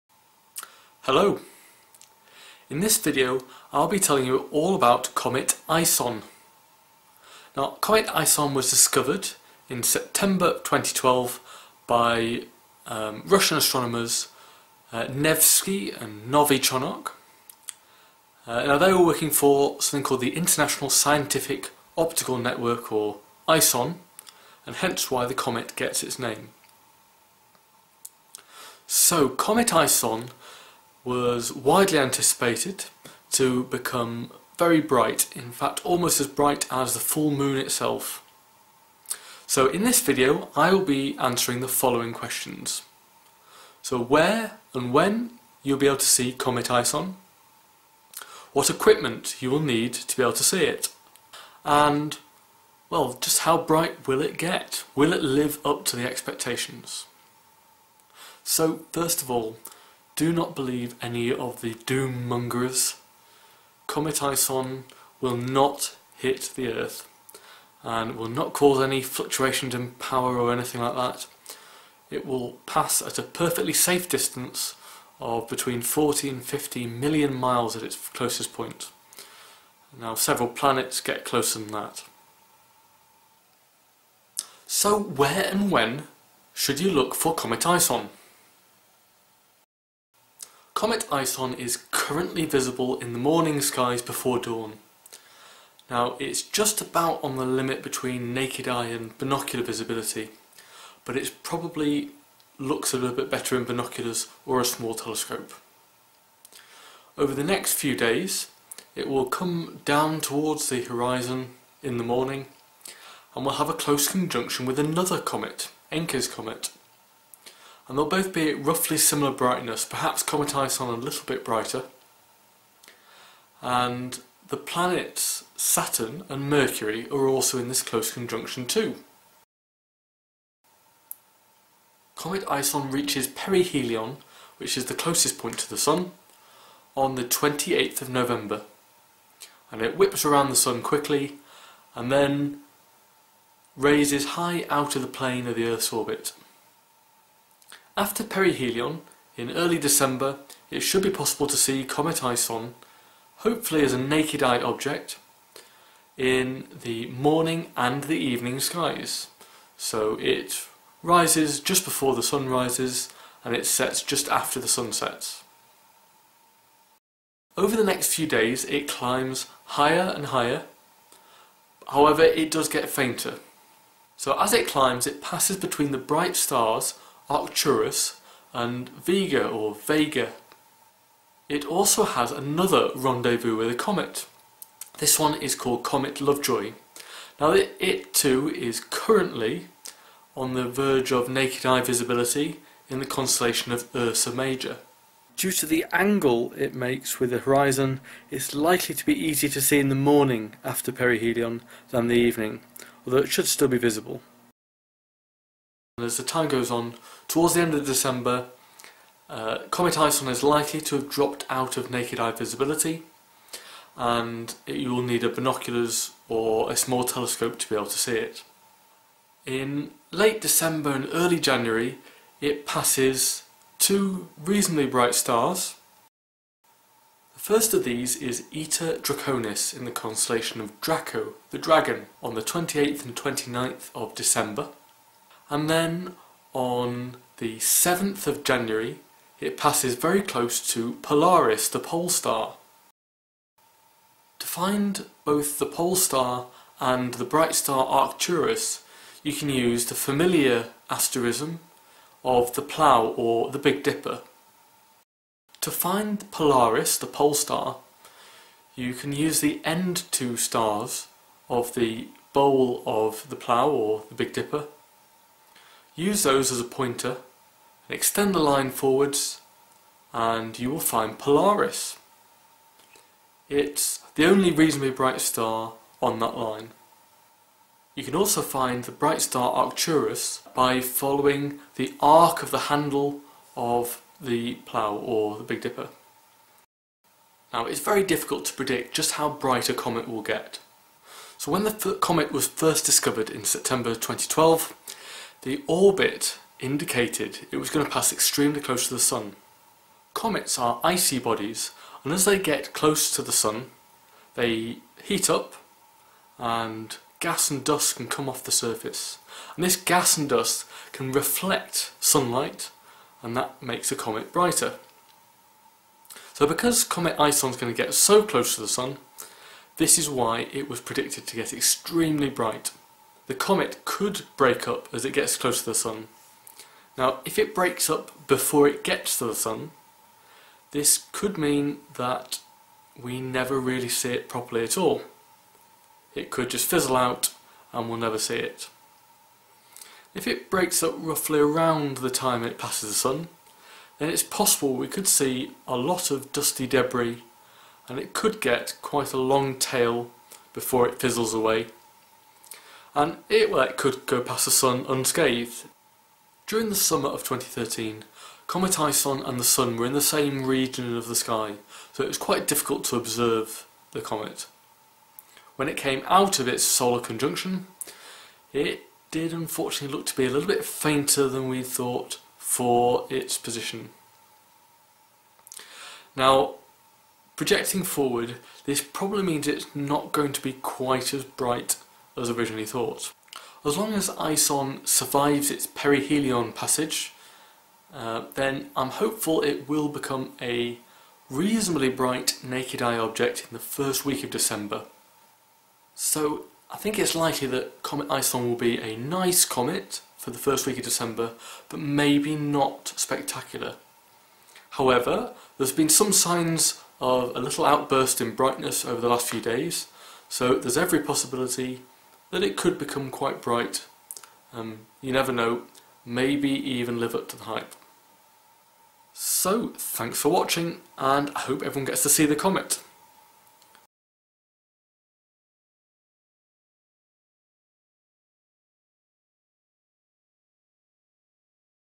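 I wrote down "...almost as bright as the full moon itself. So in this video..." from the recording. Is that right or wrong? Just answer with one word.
right.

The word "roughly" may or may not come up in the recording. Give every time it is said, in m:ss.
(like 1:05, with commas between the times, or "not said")
1:58, 5:40.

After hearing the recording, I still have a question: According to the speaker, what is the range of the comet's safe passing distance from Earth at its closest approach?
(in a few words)
40 to 50 million miles.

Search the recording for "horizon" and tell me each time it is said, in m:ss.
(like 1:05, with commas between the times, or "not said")
1:50, 3:17.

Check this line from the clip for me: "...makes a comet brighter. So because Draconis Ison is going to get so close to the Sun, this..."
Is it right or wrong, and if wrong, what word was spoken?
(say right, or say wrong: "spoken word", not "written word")
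wrong: "Comet", not "Draconis".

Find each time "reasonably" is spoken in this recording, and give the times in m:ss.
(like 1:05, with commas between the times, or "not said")
3:44, 4:34, 6:31.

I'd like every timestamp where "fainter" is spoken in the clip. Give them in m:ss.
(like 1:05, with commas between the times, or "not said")
2:52, 6:10.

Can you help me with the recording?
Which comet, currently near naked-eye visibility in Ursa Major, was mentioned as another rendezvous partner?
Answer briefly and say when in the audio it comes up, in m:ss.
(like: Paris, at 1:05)
Comet Lovejoy, at 3:05.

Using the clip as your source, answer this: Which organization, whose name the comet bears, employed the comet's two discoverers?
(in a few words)
International Scientific Optical Network.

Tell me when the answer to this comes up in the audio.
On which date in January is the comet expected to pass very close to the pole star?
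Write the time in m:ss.
3:57.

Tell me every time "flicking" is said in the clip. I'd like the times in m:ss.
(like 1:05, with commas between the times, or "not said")
not said.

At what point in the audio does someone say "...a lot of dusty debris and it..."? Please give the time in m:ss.
5:45.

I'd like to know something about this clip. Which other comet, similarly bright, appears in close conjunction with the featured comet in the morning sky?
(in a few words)
Encke's comet.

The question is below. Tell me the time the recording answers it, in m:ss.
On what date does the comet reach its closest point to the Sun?
2:17.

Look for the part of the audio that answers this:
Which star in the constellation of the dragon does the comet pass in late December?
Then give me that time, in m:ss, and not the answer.
3:48.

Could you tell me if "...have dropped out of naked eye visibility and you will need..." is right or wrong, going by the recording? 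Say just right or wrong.
right.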